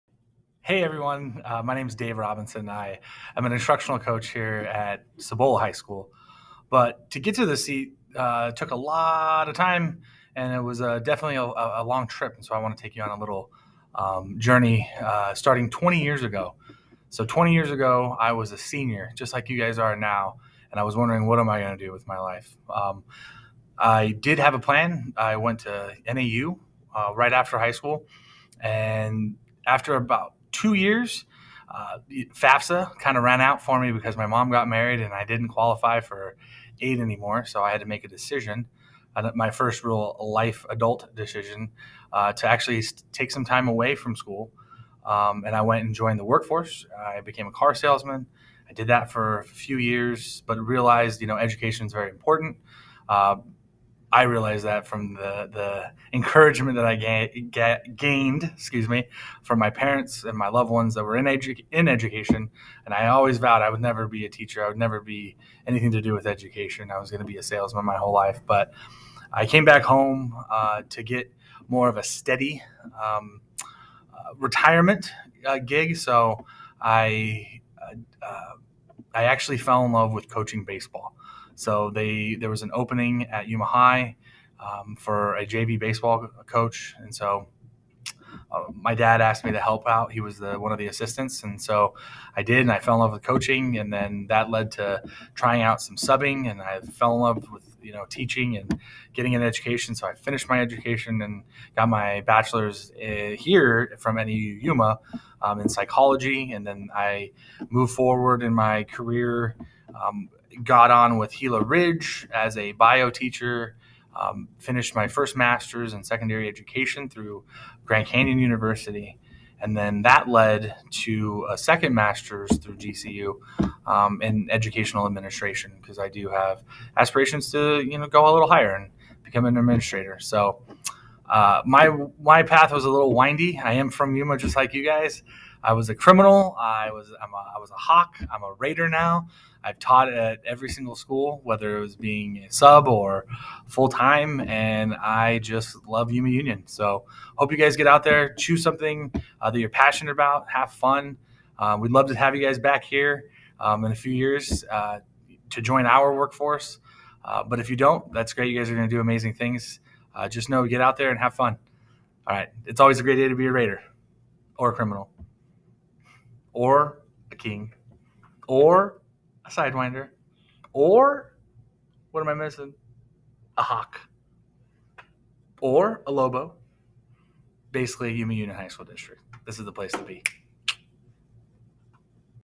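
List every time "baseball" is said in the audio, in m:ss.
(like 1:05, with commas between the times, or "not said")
1:20, 1:25.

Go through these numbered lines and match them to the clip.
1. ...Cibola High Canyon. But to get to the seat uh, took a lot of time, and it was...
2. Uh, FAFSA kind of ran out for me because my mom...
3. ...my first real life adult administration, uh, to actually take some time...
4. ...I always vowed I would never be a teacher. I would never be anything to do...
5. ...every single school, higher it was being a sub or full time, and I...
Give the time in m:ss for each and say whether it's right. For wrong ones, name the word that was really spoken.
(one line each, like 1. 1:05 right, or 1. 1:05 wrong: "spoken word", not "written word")
1. 0:05 wrong: "School", not "Canyon"
2. 0:31 right
3. 0:39 wrong: "decision", not "administration"
4. 1:02 right
5. 2:20 wrong: "whether", not "higher".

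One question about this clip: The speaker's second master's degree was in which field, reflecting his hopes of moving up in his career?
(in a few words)
Educational administration.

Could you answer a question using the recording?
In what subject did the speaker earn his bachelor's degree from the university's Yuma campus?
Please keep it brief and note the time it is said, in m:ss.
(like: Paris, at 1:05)
Psychology, at 1:45.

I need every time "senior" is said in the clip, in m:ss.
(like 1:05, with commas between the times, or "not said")
0:18.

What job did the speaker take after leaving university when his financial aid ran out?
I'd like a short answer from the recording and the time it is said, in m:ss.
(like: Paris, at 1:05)
Car salesman, at 0:47.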